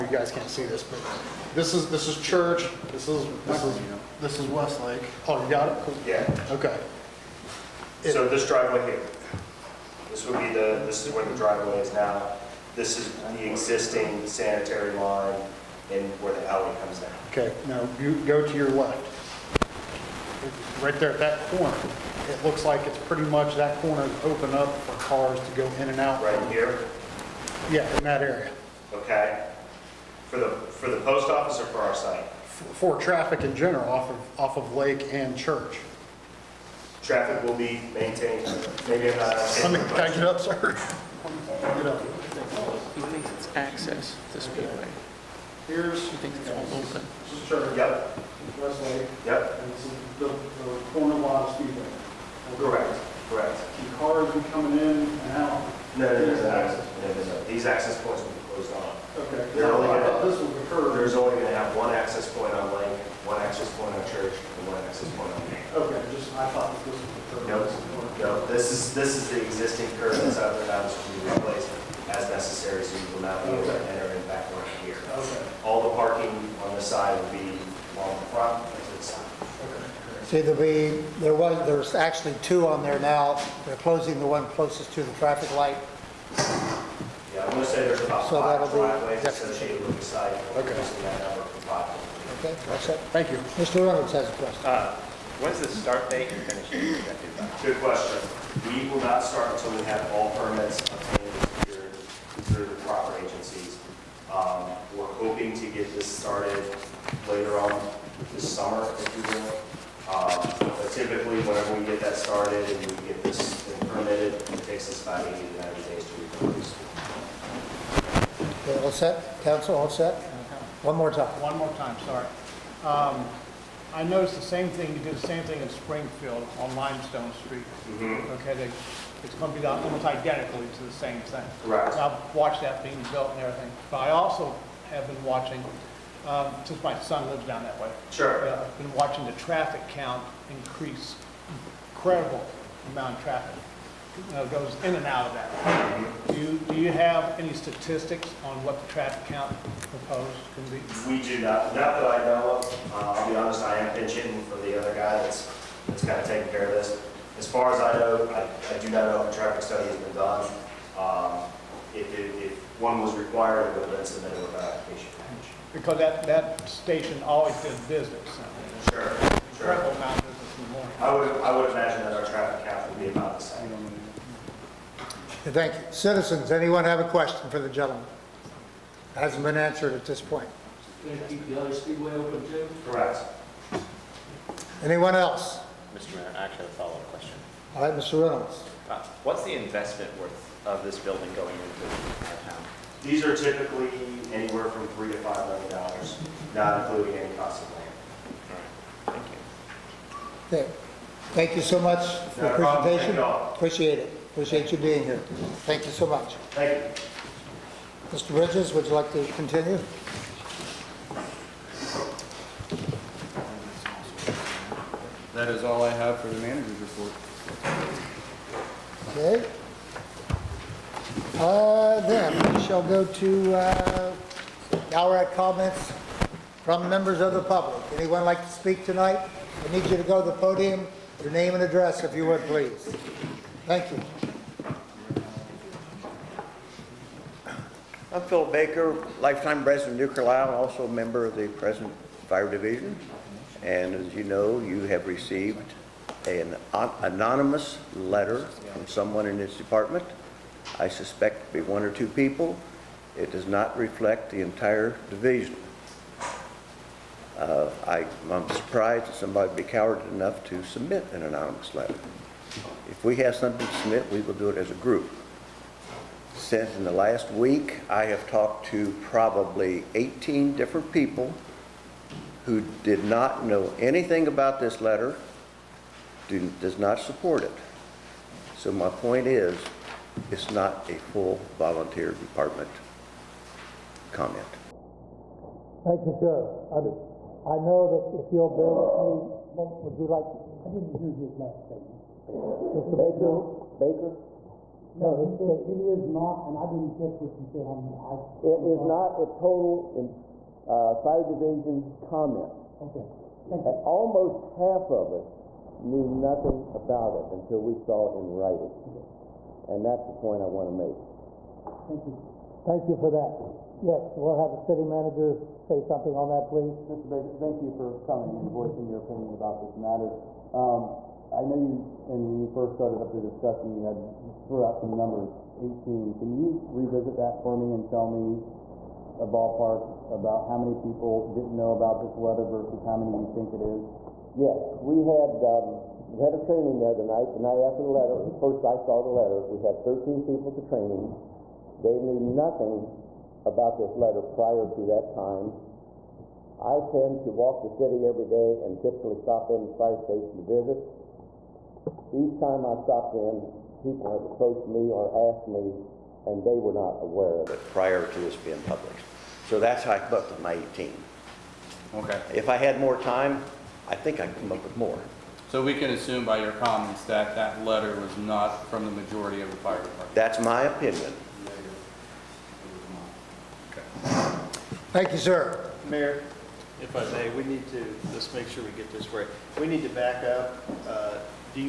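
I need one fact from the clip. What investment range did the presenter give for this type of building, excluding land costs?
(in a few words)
3 to 5 million dollars.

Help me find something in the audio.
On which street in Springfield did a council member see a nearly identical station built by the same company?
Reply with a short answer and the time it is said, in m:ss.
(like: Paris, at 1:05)
Limestone Street, at 2:06.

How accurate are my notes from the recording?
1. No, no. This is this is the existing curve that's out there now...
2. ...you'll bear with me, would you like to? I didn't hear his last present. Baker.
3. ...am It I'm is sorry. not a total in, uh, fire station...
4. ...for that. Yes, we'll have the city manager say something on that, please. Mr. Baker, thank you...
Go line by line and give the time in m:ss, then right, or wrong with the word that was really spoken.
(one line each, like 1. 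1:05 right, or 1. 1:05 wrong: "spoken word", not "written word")
1. 1:07 right
2. 4:48 wrong: "statement", not "present"
3. 4:58 wrong: "division", not "station"
4. 5:12 right.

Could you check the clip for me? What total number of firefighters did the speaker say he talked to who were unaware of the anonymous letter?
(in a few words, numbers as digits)
18.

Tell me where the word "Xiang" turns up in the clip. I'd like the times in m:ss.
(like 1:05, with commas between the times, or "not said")
not said.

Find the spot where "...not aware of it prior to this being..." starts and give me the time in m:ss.
5:56.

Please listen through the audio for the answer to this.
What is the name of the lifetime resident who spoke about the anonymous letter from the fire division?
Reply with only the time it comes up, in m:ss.
3:58.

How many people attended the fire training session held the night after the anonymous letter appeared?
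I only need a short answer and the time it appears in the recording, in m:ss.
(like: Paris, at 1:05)
13, at 5:39.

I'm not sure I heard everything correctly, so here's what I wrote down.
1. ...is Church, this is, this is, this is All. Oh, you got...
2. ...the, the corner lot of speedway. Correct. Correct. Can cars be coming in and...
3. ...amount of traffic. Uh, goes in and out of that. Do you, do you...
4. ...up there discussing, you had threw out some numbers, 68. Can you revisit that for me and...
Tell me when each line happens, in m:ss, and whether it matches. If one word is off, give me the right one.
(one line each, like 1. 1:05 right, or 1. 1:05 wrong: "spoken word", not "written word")
1. 0:02 wrong: "Westlake", not "All"
2. 0:50 right
3. 2:22 right
4. 5:23 wrong: "18", not "68".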